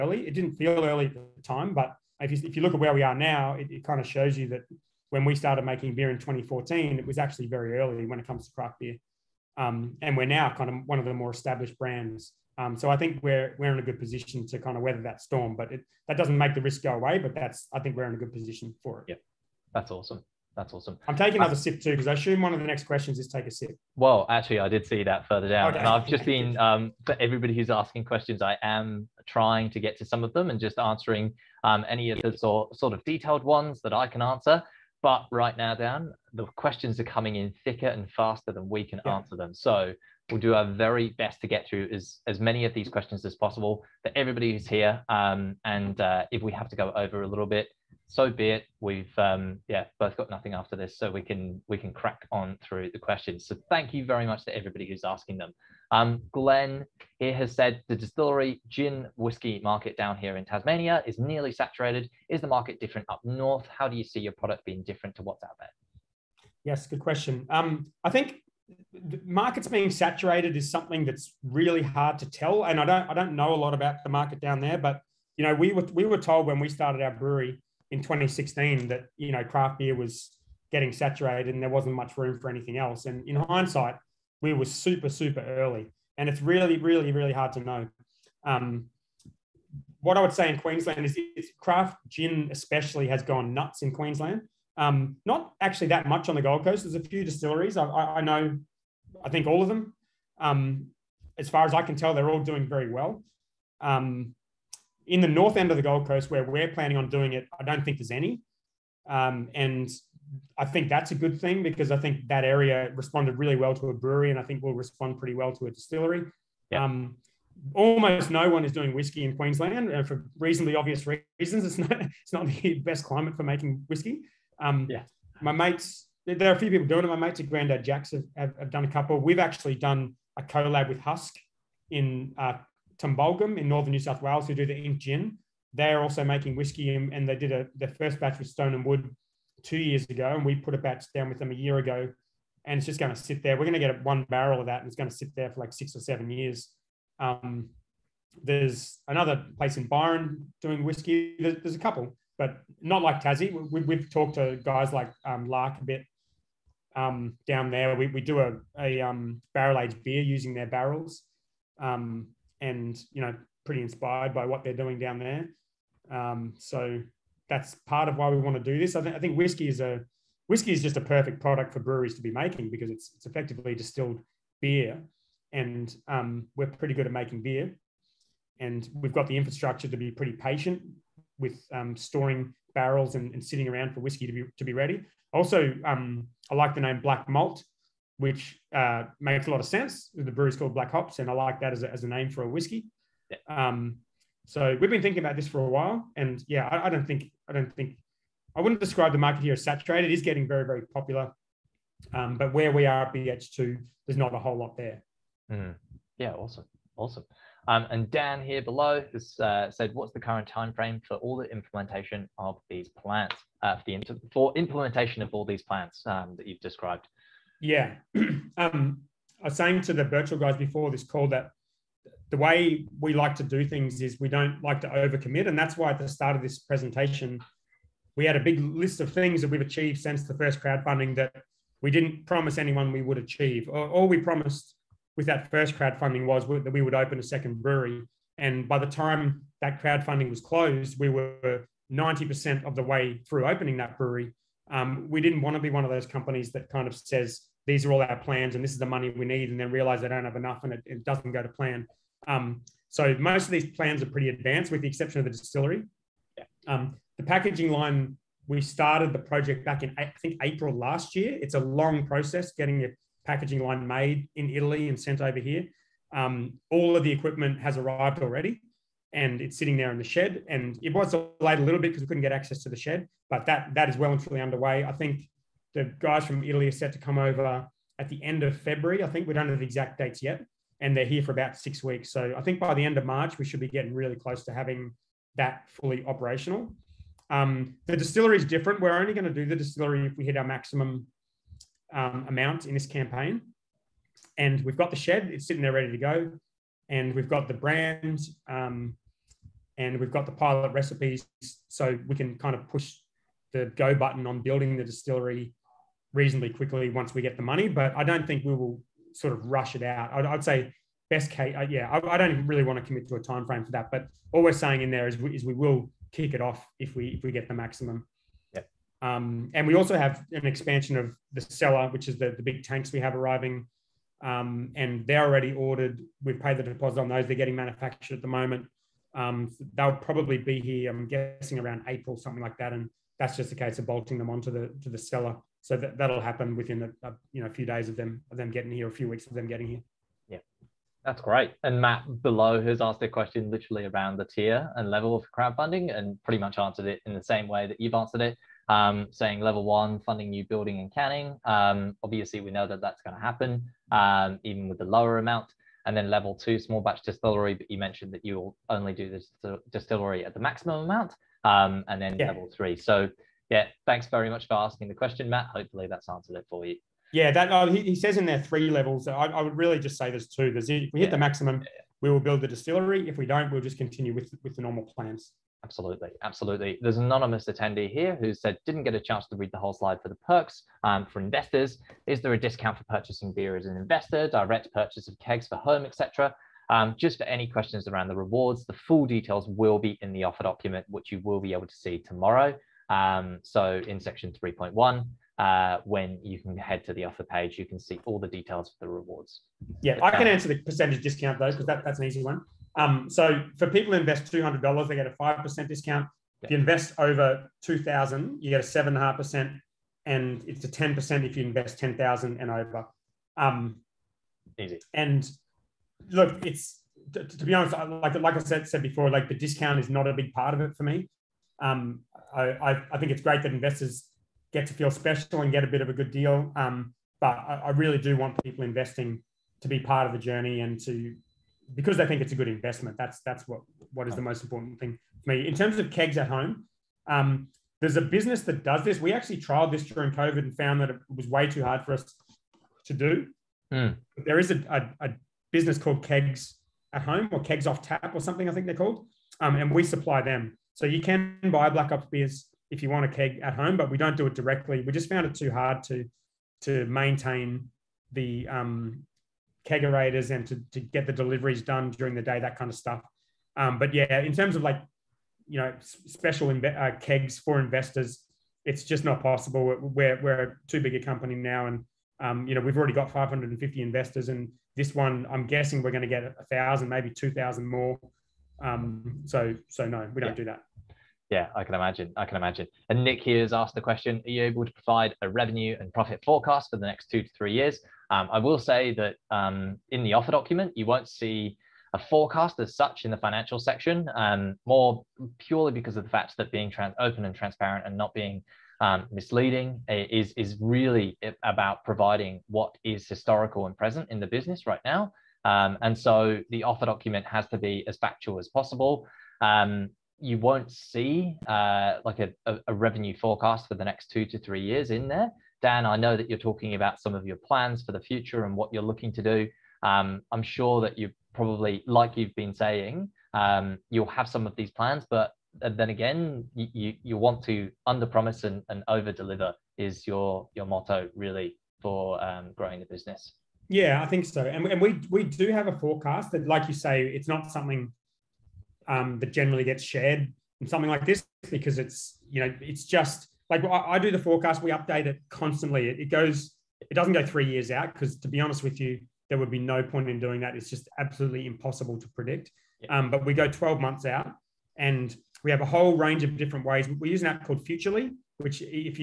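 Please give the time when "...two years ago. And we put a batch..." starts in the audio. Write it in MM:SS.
02:19.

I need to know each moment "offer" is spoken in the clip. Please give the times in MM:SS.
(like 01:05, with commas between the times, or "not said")
06:30, 06:37, 08:10, 08:26.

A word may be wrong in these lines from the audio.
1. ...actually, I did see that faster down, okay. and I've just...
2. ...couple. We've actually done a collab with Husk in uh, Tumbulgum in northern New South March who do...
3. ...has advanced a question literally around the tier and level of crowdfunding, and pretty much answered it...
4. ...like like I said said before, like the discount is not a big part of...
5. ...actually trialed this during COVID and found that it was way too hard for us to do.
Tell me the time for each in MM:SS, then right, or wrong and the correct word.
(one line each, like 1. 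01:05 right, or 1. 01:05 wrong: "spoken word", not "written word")
1. 00:24 wrong: "further", not "faster"
2. 02:08 wrong: "Wales", not "March"
3. 05:42 wrong: "asked", not "advanced"
4. 06:57 right
5. 07:19 right.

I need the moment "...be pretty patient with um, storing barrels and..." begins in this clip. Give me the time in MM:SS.
02:59.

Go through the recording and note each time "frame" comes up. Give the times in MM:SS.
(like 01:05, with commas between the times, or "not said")
03:30, 05:13.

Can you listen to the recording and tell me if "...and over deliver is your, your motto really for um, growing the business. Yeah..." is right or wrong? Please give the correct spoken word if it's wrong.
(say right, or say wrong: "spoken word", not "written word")
right.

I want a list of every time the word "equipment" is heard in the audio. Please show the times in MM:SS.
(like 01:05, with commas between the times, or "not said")
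04:27.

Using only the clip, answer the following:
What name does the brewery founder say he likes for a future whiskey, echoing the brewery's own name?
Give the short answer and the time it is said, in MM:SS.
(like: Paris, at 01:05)
Black Malt, at 03:07.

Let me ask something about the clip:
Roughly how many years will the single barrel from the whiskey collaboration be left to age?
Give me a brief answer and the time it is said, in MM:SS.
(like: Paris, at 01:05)
6 or 7 years, at 02:25.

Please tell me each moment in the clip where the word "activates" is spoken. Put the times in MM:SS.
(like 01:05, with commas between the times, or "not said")
not said.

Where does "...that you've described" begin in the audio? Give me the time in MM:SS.
03:36.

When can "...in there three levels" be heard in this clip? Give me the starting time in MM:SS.
06:08.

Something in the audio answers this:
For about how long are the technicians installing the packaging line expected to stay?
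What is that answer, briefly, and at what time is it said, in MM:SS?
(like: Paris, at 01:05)
6 weeks, at 04:41.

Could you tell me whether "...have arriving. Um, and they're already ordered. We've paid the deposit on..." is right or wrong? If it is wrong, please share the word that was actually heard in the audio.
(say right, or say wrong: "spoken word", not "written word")
right.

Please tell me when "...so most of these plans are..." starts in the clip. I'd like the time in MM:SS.
04:12.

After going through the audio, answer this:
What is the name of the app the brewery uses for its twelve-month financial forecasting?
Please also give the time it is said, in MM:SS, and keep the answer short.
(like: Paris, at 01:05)
Futrli, at 09:17.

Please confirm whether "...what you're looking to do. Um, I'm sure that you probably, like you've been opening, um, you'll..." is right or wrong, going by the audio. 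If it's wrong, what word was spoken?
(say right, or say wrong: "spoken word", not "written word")
wrong: "saying", not "opening".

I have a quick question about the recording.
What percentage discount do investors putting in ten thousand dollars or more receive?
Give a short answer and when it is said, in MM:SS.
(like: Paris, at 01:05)
10%, at 06:50.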